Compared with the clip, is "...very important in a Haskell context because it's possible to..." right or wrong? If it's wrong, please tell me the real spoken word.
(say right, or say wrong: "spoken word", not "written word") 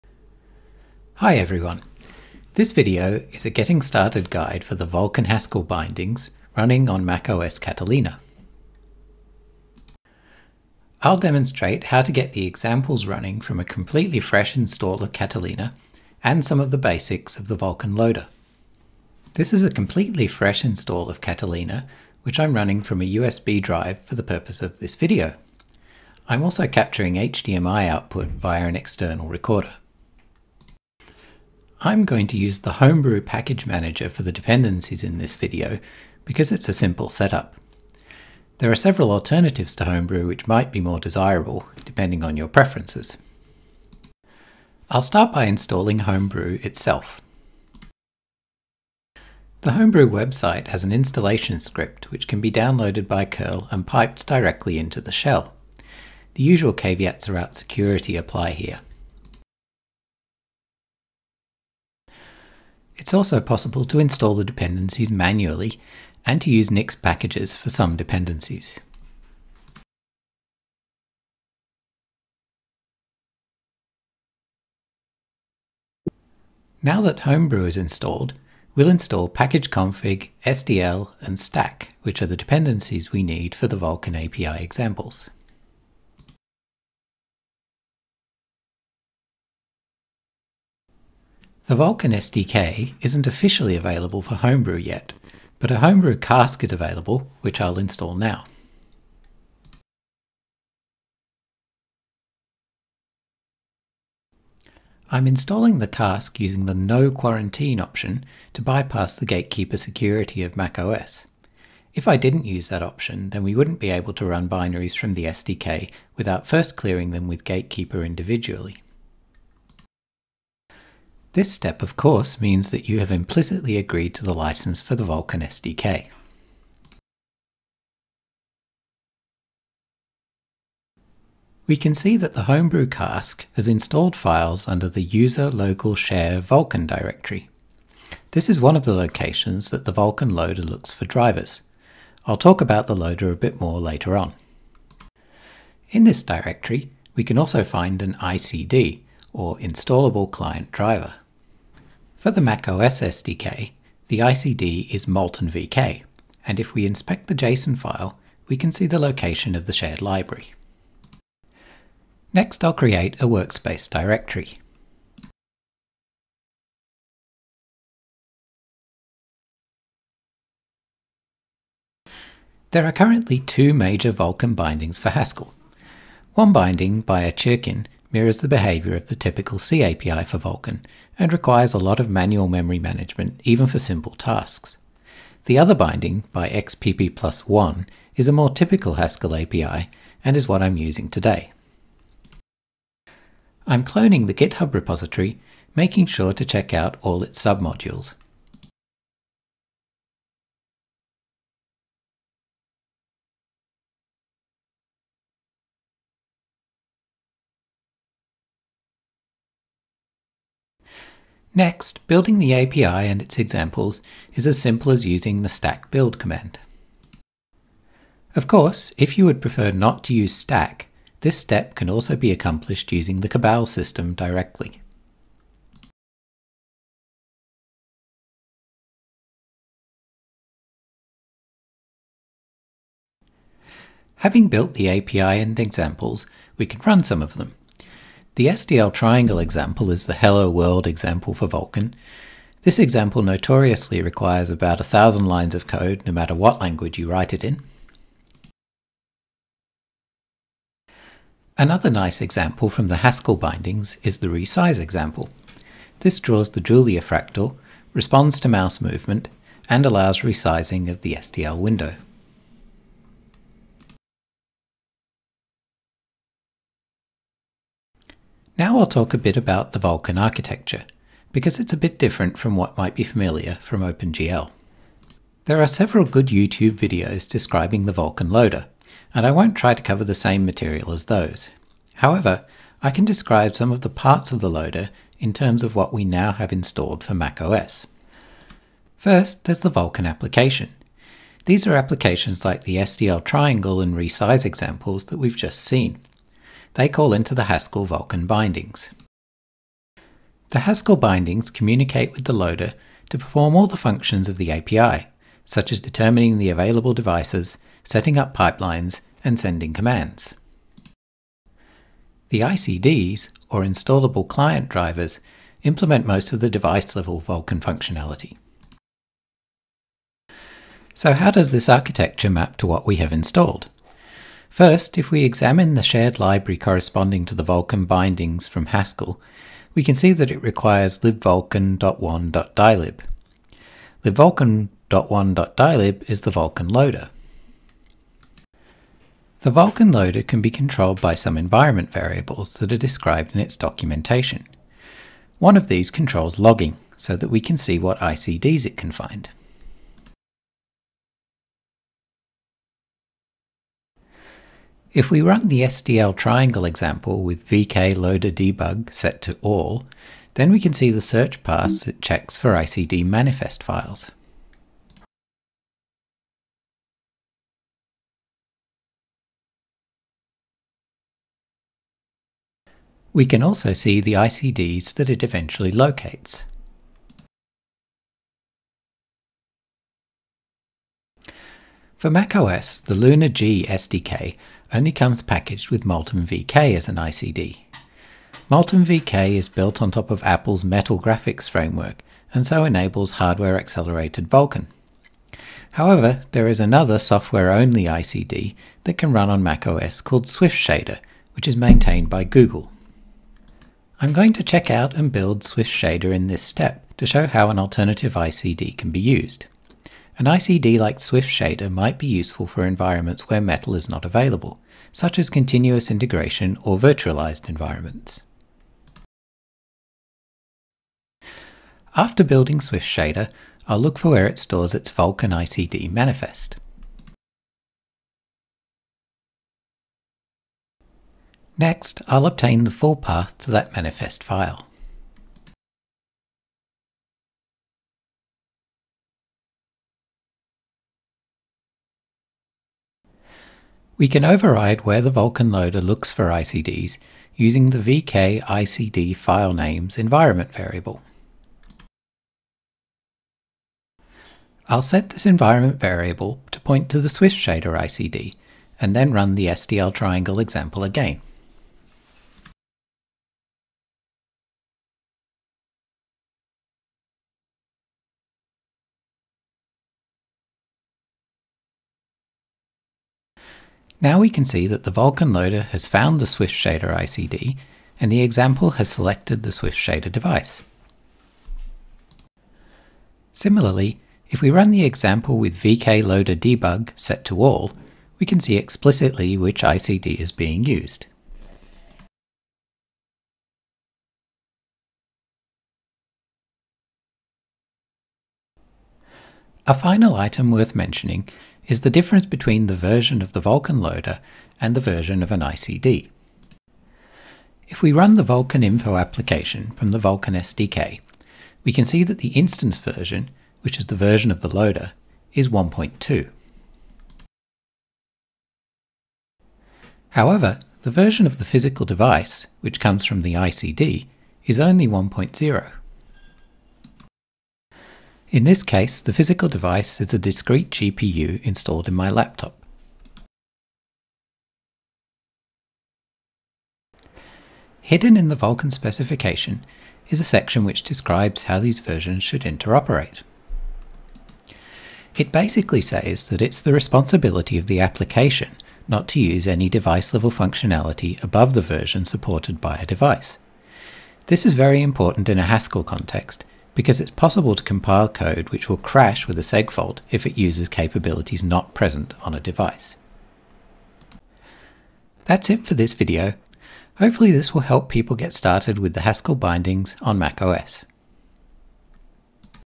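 right.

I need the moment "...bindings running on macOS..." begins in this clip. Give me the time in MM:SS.
00:05.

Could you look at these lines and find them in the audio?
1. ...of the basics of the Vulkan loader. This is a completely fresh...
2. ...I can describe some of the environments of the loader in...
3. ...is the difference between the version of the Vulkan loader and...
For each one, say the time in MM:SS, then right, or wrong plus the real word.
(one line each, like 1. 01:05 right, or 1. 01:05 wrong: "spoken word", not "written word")
1. 00:16 right
2. 04:42 wrong: "parts", not "environments"
3. 08:21 right.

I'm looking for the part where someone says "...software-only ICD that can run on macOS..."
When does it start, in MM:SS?
06:36.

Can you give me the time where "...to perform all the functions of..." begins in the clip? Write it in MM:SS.
05:03.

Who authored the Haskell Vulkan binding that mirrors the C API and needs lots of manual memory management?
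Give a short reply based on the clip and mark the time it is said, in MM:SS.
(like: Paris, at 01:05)
Chirkin, at 02:57.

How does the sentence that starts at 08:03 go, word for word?
Similarly, if we run the example with VK loader debug set to all, we can see explicitly which ICD is being used.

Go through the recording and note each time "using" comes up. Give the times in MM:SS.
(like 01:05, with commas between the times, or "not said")
01:46, 03:10, 03:35, 03:42, 07:27.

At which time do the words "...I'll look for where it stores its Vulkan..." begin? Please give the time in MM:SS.
07:03.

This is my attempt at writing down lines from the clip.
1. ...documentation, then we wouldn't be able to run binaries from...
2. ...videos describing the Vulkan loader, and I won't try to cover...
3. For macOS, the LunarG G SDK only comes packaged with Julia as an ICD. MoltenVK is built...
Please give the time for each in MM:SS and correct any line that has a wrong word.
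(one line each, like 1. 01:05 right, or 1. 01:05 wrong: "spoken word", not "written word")
1. 01:52 wrong: "option", not "documentation"
2. 04:36 right
3. 06:21 wrong: "MoltenVK", not "Julia".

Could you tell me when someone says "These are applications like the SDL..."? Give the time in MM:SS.
04:51.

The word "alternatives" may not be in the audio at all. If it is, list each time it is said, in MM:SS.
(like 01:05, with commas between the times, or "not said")
00:39, 06:47.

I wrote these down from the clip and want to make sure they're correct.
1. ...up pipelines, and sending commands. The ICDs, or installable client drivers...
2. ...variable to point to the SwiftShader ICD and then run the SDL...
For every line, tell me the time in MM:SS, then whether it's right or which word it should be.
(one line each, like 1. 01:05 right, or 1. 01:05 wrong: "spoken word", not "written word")
1. 05:08 right
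2. 07:35 right.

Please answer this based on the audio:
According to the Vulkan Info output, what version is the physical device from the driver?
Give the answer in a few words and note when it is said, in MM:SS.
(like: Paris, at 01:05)
1.0, at 08:44.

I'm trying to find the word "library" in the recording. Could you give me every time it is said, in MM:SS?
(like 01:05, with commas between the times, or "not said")
02:40, 05:26.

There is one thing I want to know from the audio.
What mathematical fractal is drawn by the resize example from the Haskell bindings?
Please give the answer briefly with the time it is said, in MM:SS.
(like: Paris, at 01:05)
Julia fractal, at 04:16.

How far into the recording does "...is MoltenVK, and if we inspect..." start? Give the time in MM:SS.
02:34.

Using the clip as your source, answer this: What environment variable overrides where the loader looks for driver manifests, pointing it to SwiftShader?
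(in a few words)
VK file names.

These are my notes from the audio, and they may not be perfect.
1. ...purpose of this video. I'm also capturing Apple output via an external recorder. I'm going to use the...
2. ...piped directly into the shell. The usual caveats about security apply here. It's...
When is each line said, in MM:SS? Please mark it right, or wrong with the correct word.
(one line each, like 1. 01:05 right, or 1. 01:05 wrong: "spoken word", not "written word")
1. 00:24 wrong: "HDMI", not "Apple"
2. 00:53 right.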